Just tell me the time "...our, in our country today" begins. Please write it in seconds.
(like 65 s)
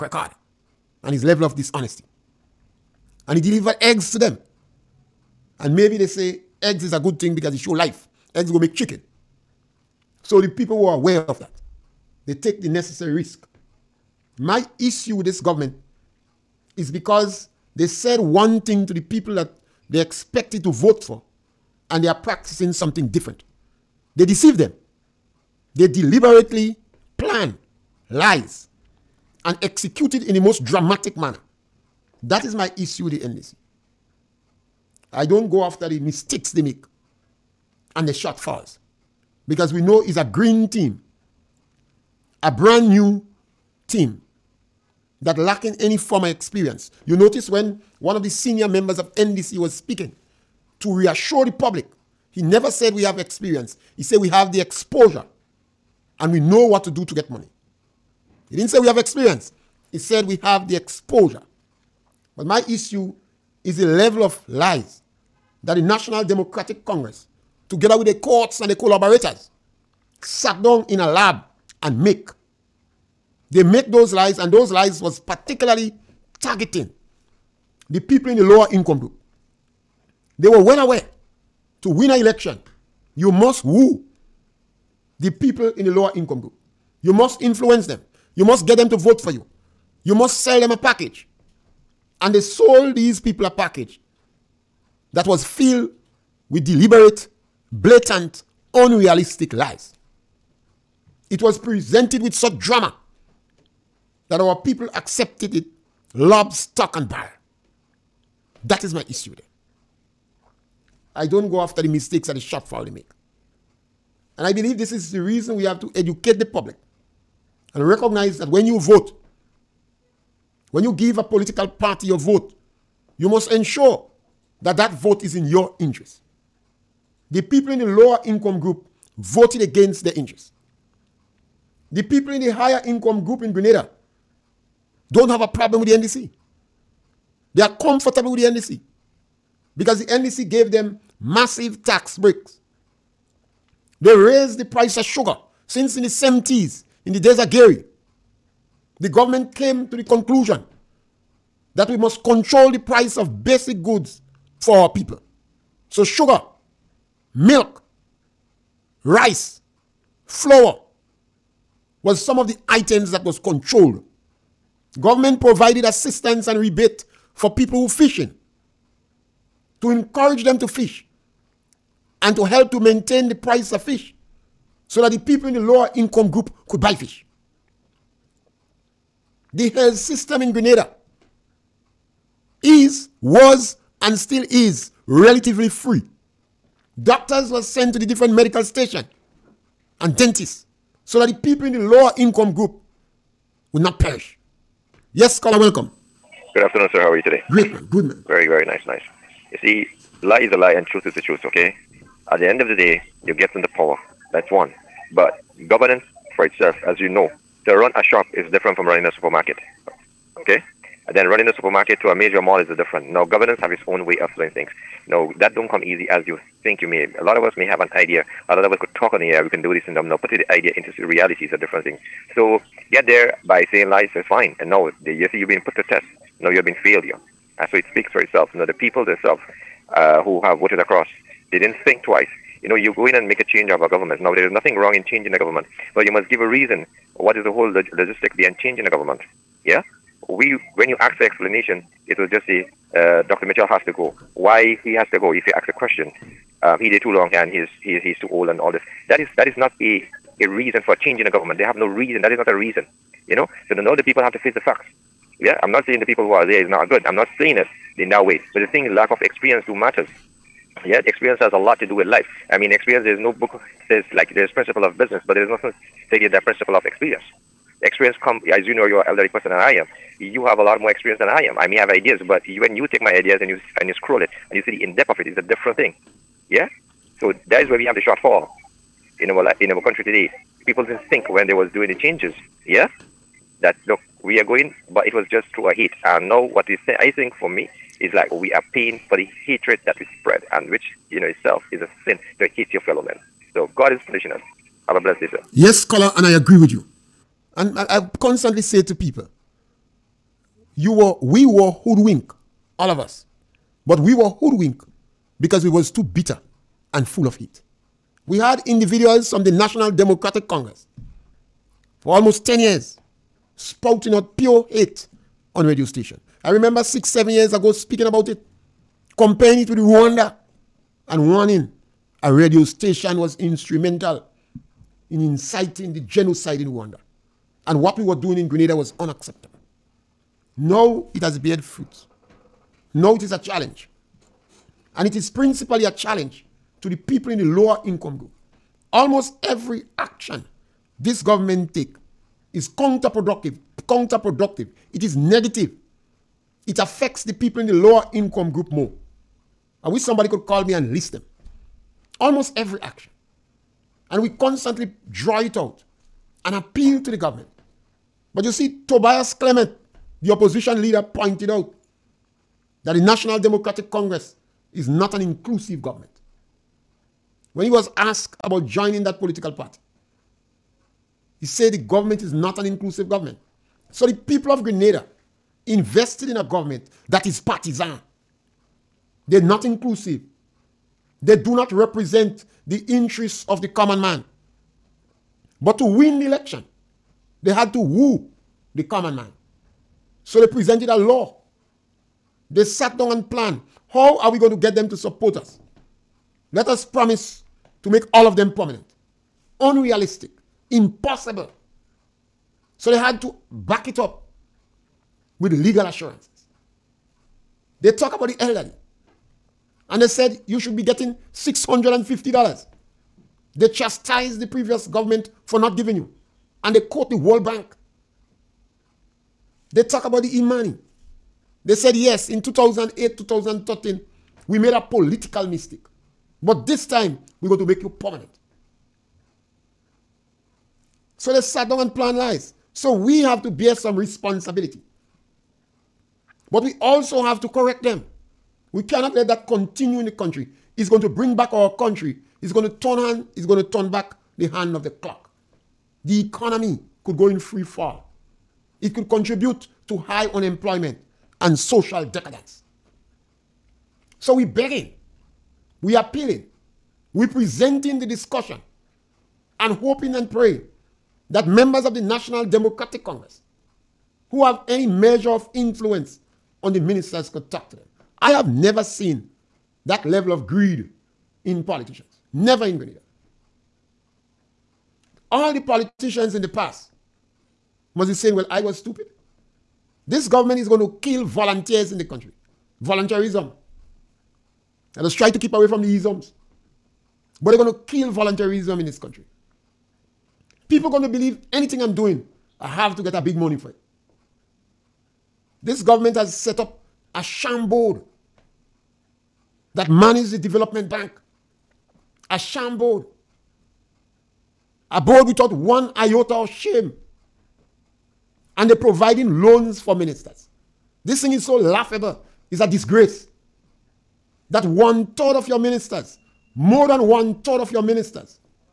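279 s.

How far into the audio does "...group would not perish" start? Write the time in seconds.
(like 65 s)
192 s.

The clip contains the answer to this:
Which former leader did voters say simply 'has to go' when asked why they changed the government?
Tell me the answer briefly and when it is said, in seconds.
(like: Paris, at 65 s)
Dr. Mitchell, at 243 s.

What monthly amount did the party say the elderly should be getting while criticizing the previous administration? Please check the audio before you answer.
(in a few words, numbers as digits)
$650.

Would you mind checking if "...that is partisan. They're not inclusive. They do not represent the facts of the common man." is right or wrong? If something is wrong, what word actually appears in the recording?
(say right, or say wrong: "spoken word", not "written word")
wrong: "interests", not "facts".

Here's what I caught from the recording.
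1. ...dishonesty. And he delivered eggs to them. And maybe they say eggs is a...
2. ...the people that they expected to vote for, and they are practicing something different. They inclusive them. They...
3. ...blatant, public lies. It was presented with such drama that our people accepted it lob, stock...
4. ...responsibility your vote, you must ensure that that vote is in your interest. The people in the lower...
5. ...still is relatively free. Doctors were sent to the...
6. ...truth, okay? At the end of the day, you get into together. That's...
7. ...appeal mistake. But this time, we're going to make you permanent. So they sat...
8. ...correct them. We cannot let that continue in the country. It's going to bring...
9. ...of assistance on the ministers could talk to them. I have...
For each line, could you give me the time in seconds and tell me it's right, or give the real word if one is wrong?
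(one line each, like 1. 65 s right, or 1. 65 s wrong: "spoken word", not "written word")
1. 1 s right
2. 18 s wrong: "deceive", not "inclusive"
3. 97 s wrong: "unrealistic", not "public"
4. 121 s wrong: "party", not "responsibility"
5. 184 s right
6. 201 s wrong: "power", not "together"
7. 424 s wrong: "political", not "appeal"
8. 437 s right
9. 465 s wrong: "influence", not "assistance".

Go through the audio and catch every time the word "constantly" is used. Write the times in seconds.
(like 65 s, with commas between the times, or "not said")
298 s, 354 s.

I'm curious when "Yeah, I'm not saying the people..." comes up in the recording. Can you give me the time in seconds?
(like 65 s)
255 s.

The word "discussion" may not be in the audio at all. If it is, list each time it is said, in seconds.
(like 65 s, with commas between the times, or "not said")
458 s.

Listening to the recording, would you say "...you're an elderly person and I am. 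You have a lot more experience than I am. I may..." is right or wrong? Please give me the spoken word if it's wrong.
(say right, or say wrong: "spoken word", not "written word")
right.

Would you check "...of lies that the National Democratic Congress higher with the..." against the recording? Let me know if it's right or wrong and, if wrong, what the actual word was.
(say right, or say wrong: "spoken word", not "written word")
wrong: "together", not "higher".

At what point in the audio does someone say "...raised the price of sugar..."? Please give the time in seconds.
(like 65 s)
144 s.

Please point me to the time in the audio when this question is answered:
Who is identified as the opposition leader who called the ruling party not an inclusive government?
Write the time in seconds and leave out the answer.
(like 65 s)
358 s.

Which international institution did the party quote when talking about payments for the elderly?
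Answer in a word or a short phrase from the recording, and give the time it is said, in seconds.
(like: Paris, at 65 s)
World Bank, at 417 s.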